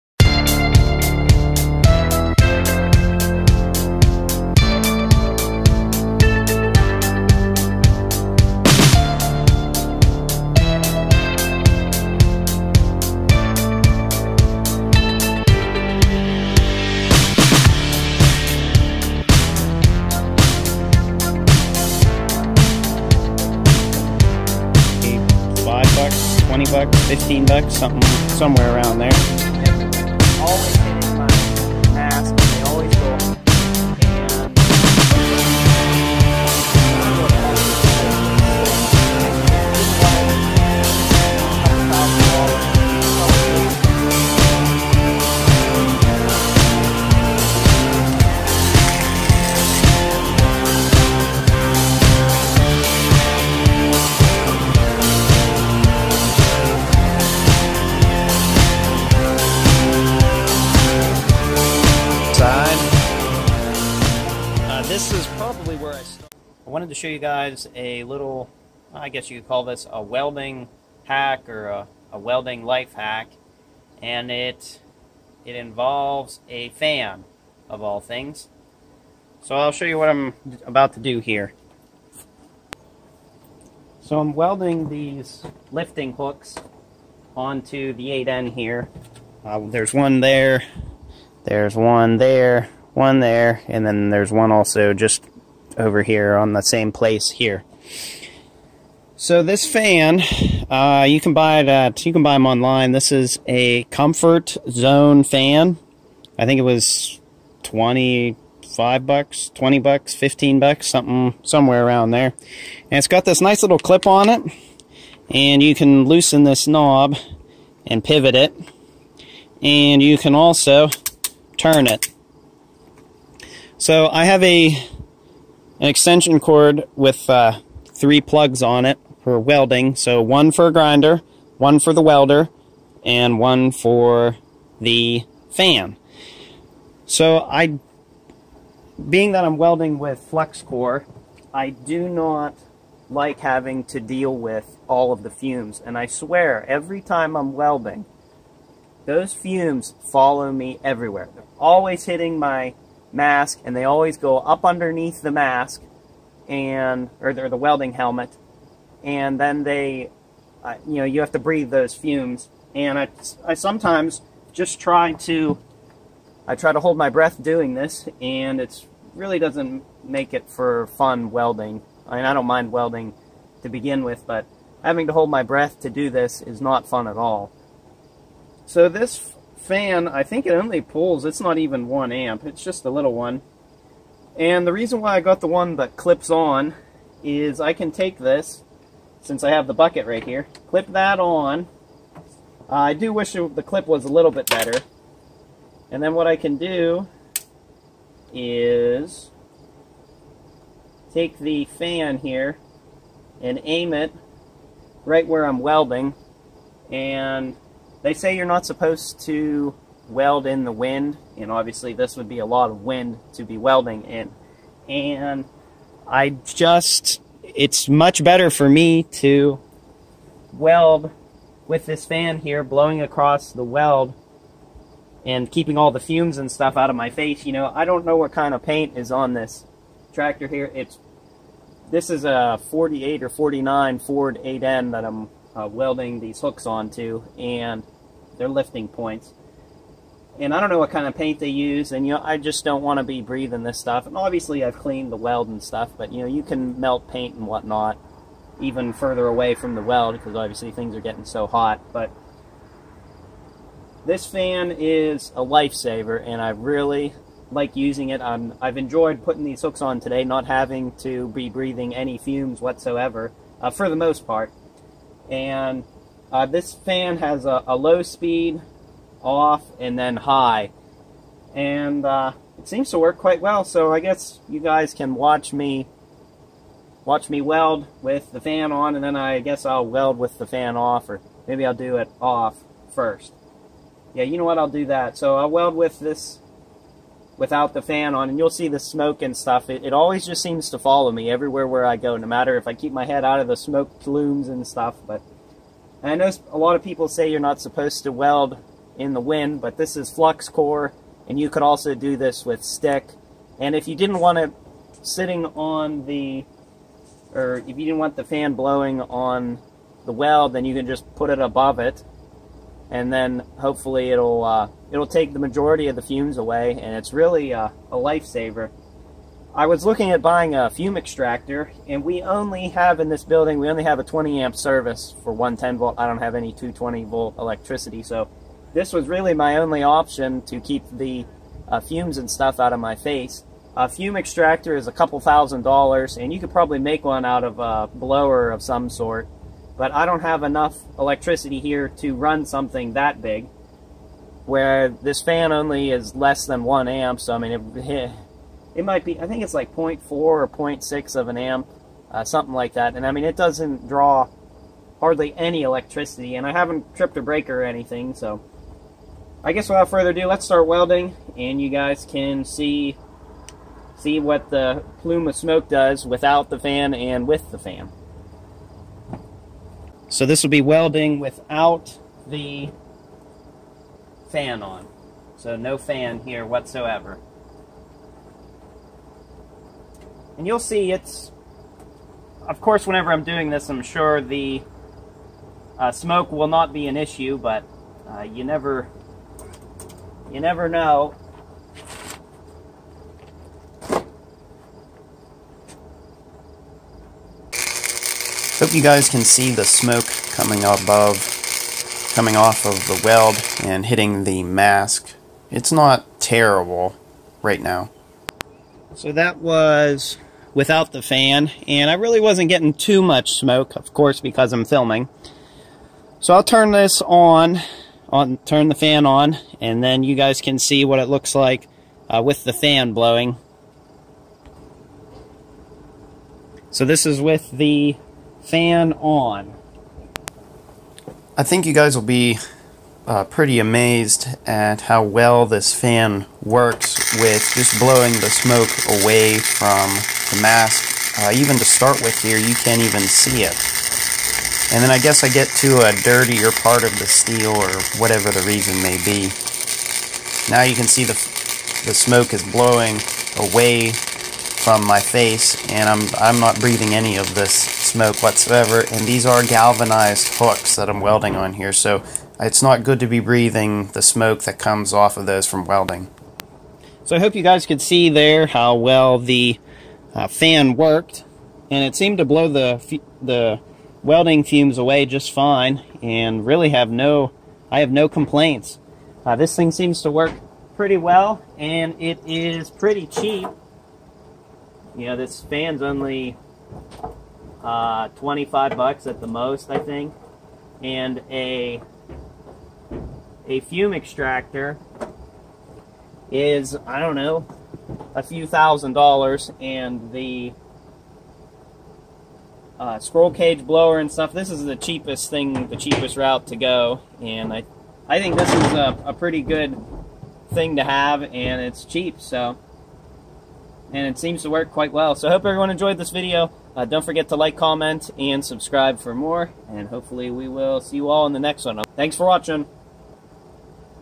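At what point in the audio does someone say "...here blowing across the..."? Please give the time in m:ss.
3:42.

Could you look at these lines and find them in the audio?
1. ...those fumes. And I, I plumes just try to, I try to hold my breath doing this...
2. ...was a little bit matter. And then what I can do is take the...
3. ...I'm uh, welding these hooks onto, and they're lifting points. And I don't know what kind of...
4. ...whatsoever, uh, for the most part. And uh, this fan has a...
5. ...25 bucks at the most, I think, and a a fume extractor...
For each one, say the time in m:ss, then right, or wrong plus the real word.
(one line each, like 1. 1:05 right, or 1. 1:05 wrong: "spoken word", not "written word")
1. 2:41 wrong: "sometimes", not "plumes"
2. 3:13 wrong: "better", not "matter"
3. 3:55 right
4. 4:22 right
5. 8:08 right.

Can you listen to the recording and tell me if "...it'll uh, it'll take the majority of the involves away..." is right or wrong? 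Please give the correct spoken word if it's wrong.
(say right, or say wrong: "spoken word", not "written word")
wrong: "fumes", not "involves".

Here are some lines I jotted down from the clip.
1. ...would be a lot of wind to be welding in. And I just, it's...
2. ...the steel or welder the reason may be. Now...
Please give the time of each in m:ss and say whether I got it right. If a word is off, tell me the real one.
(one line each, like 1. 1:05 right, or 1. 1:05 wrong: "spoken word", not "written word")
1. 3:32 right
2. 7:26 wrong: "whatever", not "welder".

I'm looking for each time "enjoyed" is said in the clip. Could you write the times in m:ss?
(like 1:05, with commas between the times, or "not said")
4:18, 8:35.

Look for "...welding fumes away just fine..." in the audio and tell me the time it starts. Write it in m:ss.
7:54.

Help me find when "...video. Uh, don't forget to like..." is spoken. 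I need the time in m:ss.
8:36.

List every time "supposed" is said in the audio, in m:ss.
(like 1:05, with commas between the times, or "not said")
3:28, 4:57.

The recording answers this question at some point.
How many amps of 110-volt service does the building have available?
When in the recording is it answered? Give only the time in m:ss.
5:24.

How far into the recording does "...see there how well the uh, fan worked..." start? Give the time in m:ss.
7:47.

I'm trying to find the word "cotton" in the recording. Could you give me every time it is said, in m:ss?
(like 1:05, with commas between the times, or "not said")
not said.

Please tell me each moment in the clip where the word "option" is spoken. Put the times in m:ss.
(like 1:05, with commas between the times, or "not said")
5:29.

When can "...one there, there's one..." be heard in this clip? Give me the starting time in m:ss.
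1:29.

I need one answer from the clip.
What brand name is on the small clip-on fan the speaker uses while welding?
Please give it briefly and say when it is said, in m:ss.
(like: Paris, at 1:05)
Comfort Zone, at 1:43.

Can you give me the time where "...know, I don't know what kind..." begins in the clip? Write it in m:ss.
3:47.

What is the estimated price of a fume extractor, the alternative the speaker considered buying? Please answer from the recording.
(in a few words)
a couple thousand dollars.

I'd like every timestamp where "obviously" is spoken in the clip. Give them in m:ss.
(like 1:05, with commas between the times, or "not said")
3:31, 4:04, 4:10.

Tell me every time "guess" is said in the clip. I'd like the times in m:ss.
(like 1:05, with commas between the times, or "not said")
1:09, 4:33, 4:39, 5:59, 7:24.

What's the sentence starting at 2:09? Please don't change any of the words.
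So one for a grinder, one for the welder, and one for the fan.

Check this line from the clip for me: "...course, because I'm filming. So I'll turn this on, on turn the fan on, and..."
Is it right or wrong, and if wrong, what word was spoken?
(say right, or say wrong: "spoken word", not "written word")
right.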